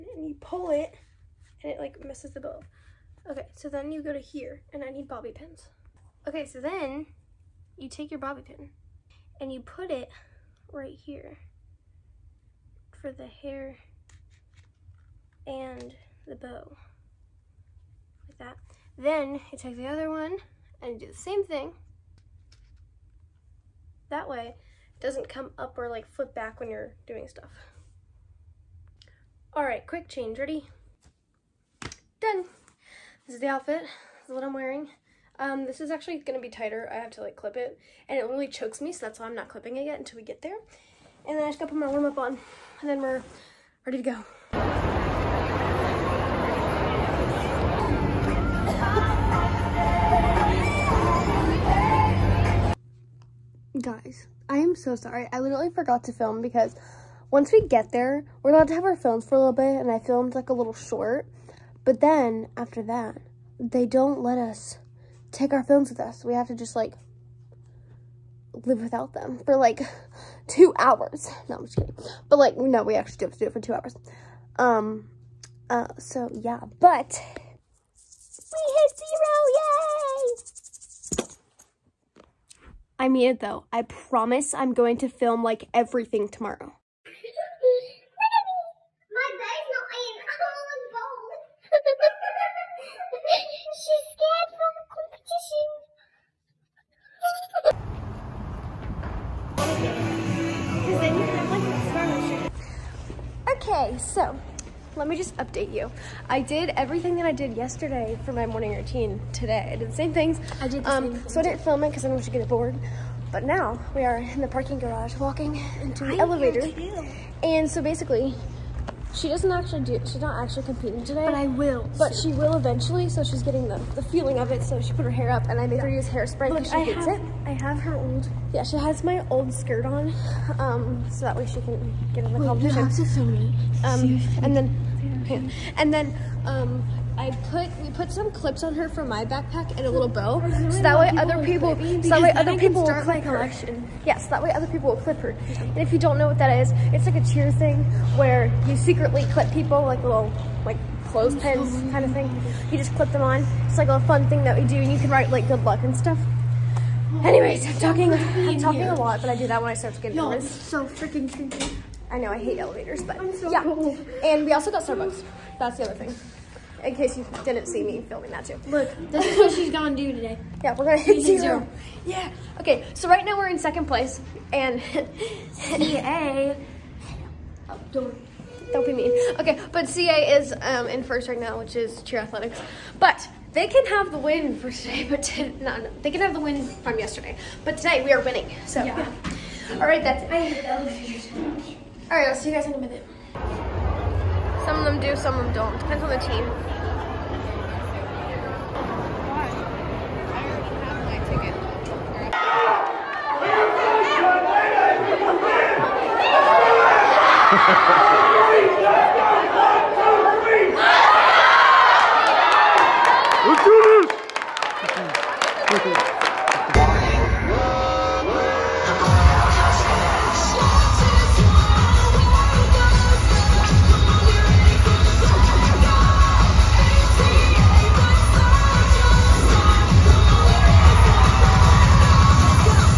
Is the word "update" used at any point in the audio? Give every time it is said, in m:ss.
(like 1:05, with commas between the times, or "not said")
1:45.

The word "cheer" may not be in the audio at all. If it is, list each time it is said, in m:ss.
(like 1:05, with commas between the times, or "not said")
2:27, 3:02.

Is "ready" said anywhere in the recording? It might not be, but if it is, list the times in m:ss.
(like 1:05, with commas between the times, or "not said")
0:30, 0:43.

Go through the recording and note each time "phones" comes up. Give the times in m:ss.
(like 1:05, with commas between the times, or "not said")
0:58, 1:05.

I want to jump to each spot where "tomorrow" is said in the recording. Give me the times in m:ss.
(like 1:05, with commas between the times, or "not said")
1:26.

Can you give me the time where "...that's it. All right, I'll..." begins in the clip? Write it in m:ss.
3:10.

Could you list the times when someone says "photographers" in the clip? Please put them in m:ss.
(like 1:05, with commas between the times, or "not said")
not said.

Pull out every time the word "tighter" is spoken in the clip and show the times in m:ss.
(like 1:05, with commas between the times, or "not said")
0:36.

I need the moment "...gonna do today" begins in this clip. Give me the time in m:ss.
2:49.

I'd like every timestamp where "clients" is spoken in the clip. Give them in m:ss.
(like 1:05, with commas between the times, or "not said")
not said.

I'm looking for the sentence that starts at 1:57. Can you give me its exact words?
And so basically, she doesn't actually do, she's not actually competing today.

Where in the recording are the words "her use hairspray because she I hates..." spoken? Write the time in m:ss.
2:05.